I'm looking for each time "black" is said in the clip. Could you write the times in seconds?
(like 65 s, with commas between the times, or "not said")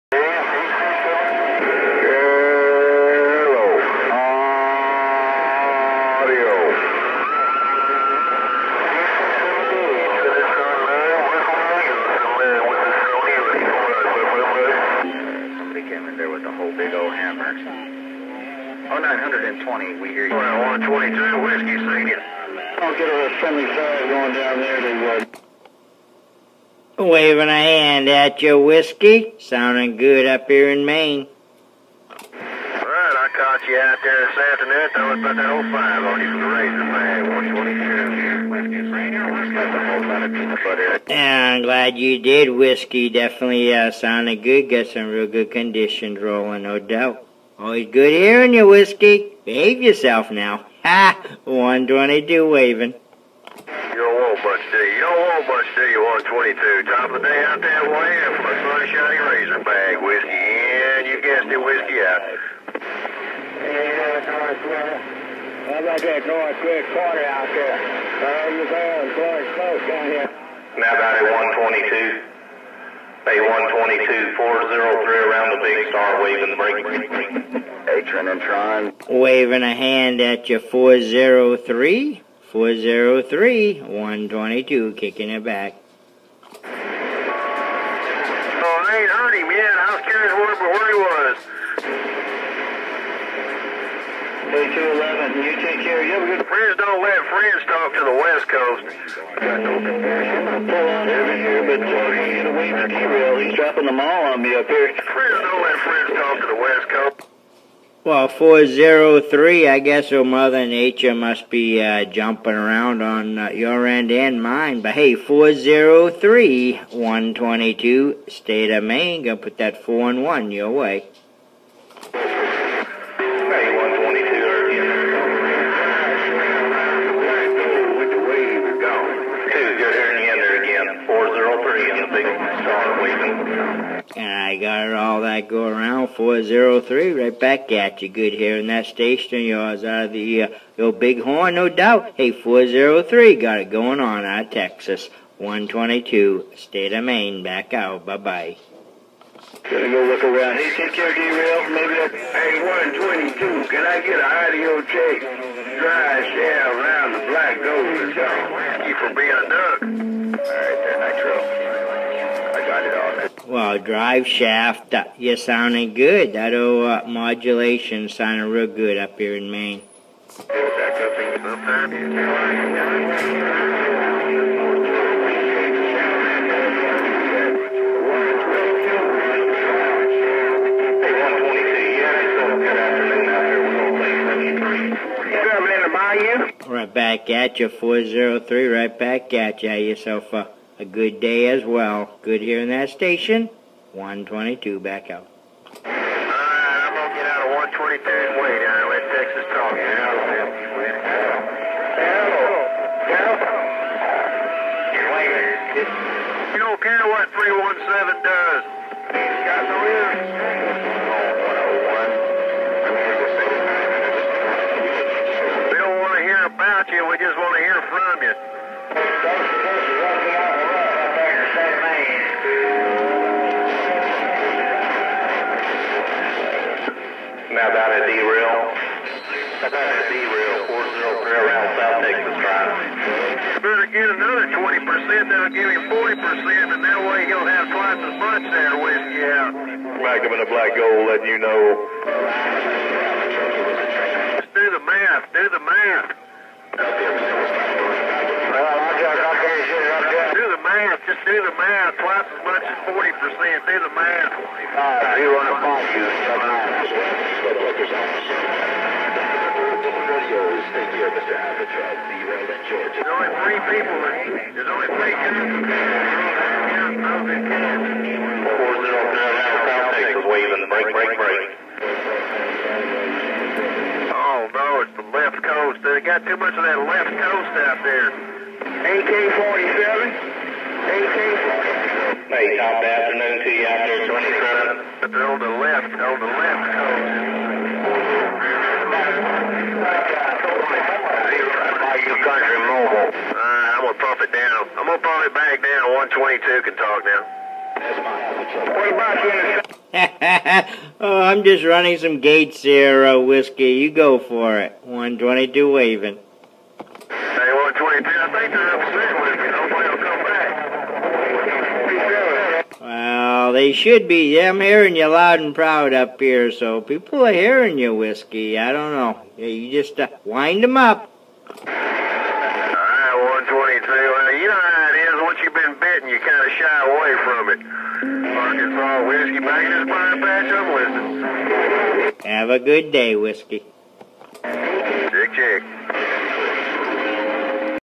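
157 s, 240 s.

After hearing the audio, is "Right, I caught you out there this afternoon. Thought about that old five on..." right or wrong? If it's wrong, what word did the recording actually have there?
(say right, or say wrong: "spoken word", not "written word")
right.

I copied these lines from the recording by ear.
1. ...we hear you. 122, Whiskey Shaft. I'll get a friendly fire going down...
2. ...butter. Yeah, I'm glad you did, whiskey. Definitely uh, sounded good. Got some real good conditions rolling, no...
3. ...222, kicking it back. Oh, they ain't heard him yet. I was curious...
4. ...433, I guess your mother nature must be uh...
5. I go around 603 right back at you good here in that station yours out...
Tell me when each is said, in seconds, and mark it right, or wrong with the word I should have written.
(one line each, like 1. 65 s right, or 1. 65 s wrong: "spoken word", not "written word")
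1. 19 s wrong: "Senior", not "Shaft"
2. 40 s right
3. 83 s wrong: "122", not "222"
4. 108 s wrong: "403", not "433"
5. 135 s wrong: "403", not "603".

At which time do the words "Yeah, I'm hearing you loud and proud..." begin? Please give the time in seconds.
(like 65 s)
314 s.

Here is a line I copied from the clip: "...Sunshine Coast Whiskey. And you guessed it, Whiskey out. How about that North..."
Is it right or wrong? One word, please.
wrong.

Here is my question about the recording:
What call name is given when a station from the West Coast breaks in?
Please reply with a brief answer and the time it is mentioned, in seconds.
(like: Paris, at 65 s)
AK forty seven, at 278 s.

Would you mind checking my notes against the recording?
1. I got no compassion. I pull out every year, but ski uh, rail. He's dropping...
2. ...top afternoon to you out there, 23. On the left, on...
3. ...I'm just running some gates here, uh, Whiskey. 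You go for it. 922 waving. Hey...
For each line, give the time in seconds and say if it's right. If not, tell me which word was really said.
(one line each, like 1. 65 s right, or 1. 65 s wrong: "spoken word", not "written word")
1. 98 s right
2. 282 s wrong: "27", not "23"
3. 301 s wrong: "122", not "922".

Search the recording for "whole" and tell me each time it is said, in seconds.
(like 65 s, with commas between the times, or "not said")
39 s.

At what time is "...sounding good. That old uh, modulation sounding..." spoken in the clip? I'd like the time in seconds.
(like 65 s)
165 s.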